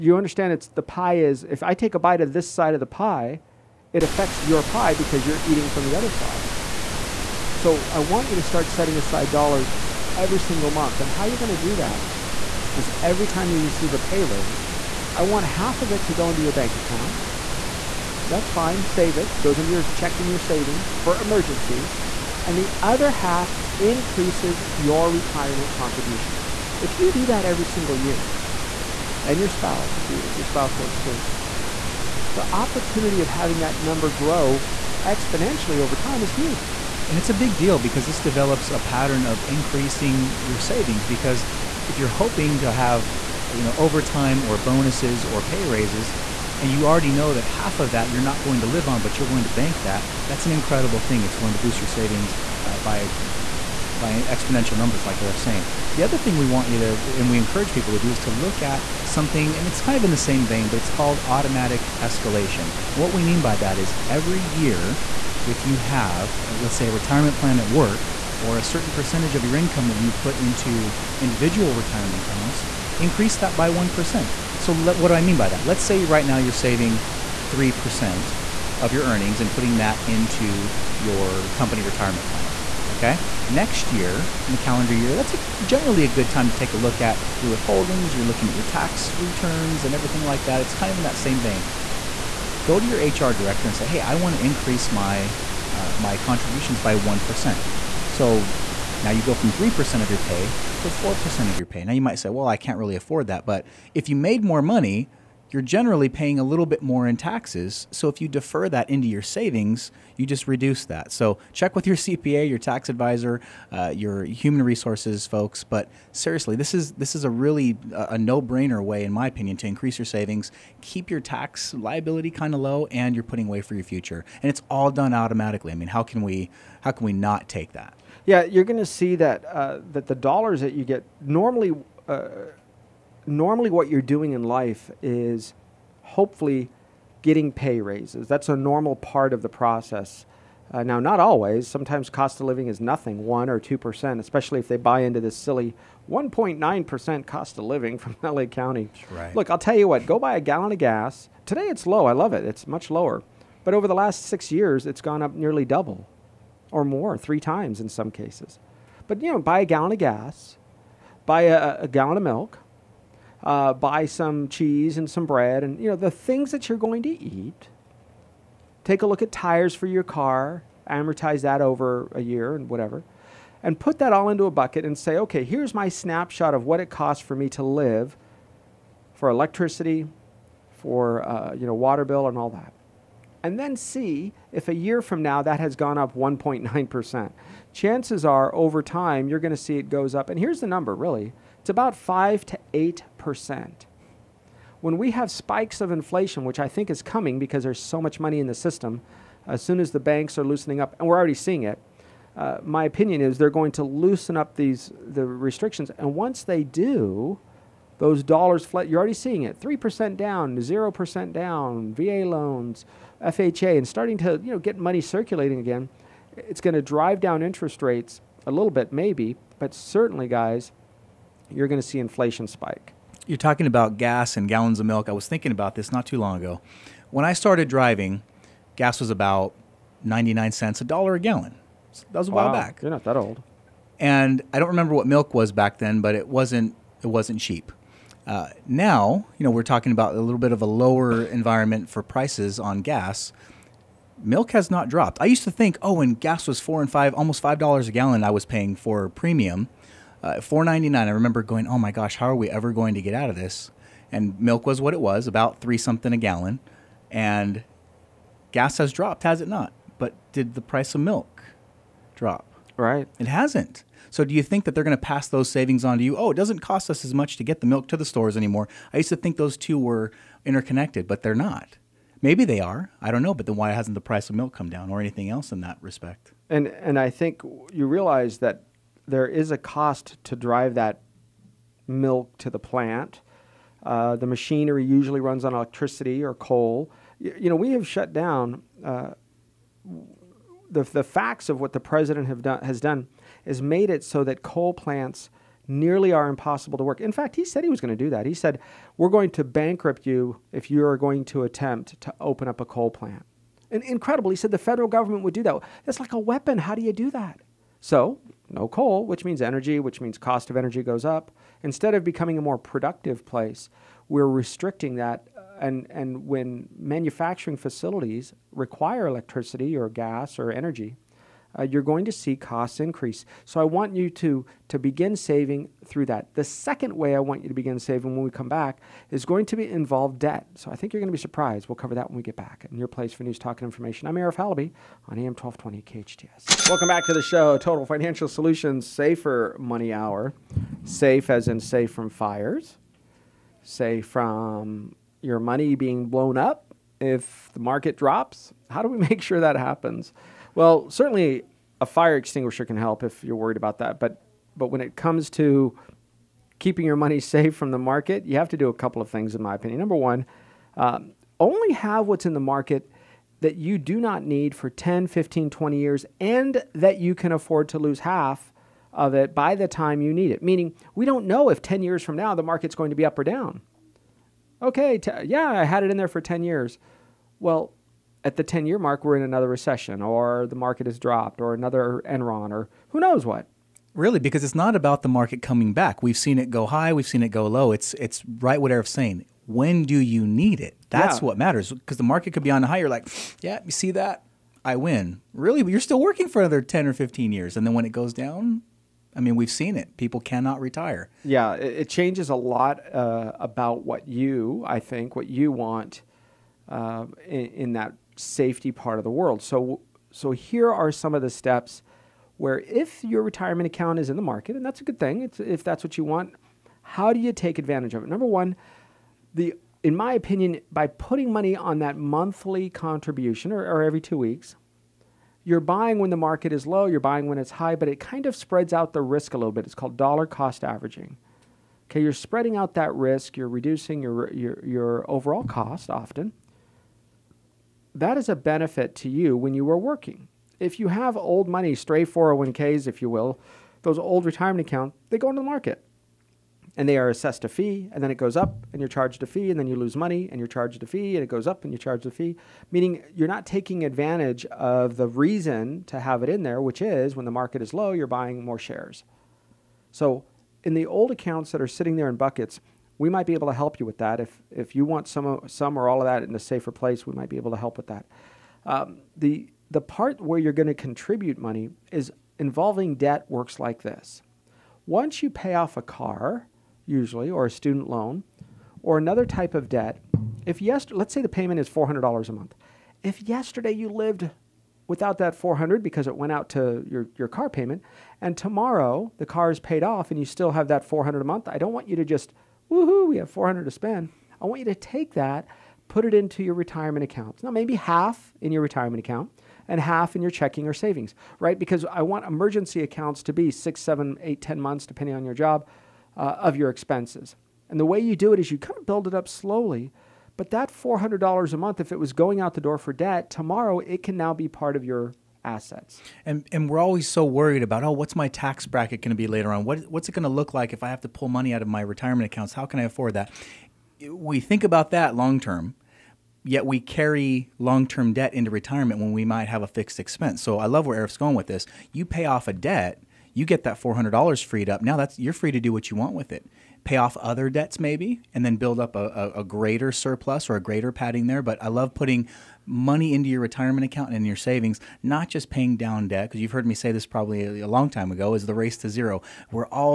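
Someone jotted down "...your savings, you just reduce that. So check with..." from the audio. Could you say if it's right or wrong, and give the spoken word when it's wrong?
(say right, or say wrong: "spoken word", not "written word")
right.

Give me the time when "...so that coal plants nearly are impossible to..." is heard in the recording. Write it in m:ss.
4:54.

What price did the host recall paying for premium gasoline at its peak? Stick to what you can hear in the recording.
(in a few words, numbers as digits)
4.99.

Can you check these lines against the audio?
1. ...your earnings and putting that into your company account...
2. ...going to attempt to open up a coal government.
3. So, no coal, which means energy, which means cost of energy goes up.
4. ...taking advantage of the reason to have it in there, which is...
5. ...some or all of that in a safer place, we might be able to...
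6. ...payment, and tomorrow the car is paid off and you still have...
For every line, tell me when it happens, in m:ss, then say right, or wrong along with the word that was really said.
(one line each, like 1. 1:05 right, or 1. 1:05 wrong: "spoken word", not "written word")
1. 1:18 wrong: "retirement", not "account"
2. 5:00 wrong: "plant", not "government"
3. 5:07 right
4. 7:33 right
5. 7:45 right
6. 8:07 right.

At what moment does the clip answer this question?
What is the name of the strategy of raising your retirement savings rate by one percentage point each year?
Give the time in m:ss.
1:01.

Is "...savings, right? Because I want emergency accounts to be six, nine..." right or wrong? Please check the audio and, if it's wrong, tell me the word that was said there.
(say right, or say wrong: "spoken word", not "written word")
wrong: "seven", not "nine".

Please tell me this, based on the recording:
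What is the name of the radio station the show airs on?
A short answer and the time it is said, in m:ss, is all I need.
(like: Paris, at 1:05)
KHTS, at 5:35.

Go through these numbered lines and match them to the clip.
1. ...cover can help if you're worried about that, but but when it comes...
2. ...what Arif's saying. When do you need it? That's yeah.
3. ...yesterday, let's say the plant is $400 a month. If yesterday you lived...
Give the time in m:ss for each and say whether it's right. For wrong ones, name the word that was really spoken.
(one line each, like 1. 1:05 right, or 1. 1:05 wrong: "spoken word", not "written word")
1. 5:52 wrong: "extinguisher", not "cover"
2. 6:28 right
3. 8:00 wrong: "payment", not "plant".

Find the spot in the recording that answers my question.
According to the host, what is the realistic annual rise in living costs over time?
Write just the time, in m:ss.
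3:11.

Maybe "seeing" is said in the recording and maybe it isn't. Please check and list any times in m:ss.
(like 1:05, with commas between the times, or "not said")
3:21, 3:29.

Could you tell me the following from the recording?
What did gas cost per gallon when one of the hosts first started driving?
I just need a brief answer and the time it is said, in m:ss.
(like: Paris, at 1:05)
99 cents, at 3:50.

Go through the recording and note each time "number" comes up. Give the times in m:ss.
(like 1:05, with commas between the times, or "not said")
0:33, 0:54, 3:10, 5:59, 6:58.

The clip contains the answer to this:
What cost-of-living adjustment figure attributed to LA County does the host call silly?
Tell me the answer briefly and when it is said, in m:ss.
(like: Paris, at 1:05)
1.9 percent, at 2:26.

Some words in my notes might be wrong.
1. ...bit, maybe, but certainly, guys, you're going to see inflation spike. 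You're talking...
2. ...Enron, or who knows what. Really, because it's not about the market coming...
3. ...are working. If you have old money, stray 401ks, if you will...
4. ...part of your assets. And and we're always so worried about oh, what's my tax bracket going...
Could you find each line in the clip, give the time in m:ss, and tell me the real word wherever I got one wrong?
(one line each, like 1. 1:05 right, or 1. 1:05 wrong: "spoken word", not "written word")
1. 3:38 right
2. 6:22 right
3. 7:19 right
4. 8:34 right.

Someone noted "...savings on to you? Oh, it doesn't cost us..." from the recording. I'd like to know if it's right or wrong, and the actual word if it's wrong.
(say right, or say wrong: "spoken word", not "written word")
right.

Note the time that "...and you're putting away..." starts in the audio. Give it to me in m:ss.
2:02.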